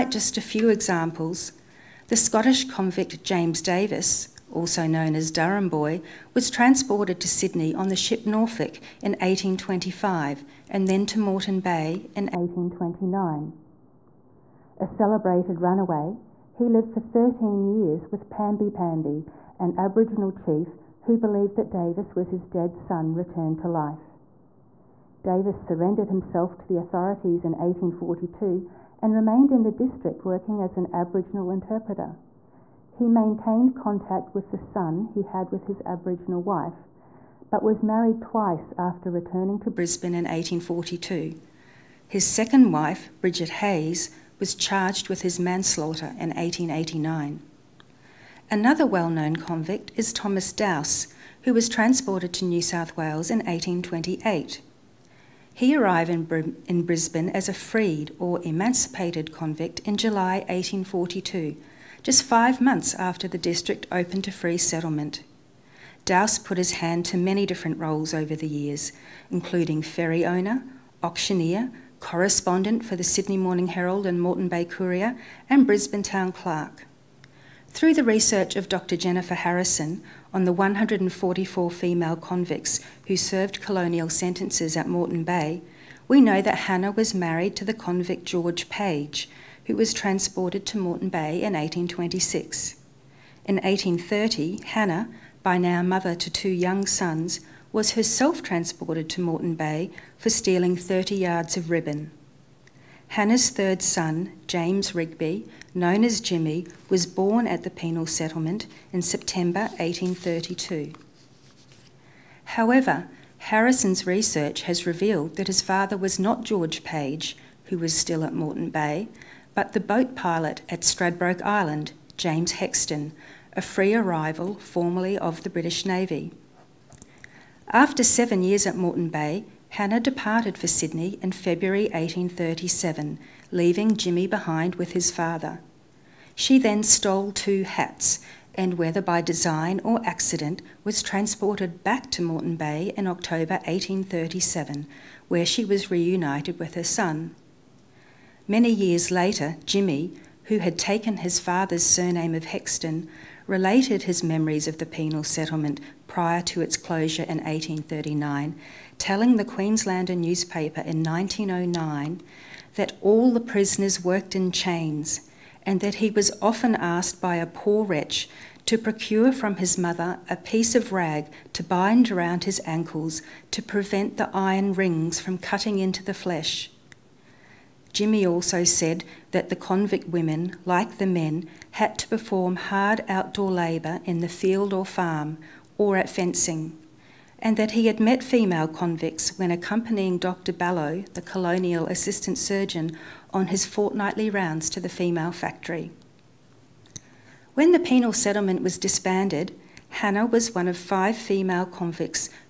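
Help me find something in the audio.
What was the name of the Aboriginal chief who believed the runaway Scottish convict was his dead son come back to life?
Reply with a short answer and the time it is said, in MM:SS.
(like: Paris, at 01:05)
Pamby Pamby, at 00:18.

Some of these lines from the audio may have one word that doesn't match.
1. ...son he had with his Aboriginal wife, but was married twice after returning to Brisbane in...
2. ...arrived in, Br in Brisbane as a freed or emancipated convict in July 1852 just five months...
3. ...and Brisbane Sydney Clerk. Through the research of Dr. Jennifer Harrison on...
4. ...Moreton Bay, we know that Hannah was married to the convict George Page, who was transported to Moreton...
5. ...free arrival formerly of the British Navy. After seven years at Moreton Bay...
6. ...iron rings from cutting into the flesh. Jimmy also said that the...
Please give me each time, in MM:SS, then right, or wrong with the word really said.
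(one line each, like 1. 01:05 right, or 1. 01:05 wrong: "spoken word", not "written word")
1. 00:34 right
2. 00:55 wrong: "1842", not "1852"
3. 01:15 wrong: "Town", not "Sydney"
4. 01:24 right
5. 02:03 right
6. 02:54 right.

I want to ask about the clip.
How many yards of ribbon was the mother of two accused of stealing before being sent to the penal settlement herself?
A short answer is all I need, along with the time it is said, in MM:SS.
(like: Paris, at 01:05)
30, at 01:40.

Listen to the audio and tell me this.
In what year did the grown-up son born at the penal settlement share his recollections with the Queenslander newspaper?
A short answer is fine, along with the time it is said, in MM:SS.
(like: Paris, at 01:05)
1909, at 02:41.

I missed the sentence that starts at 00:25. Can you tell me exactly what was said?
Davis surrendered himself to the authorities in 1842 and remained in the district working as an Aboriginal interpreter.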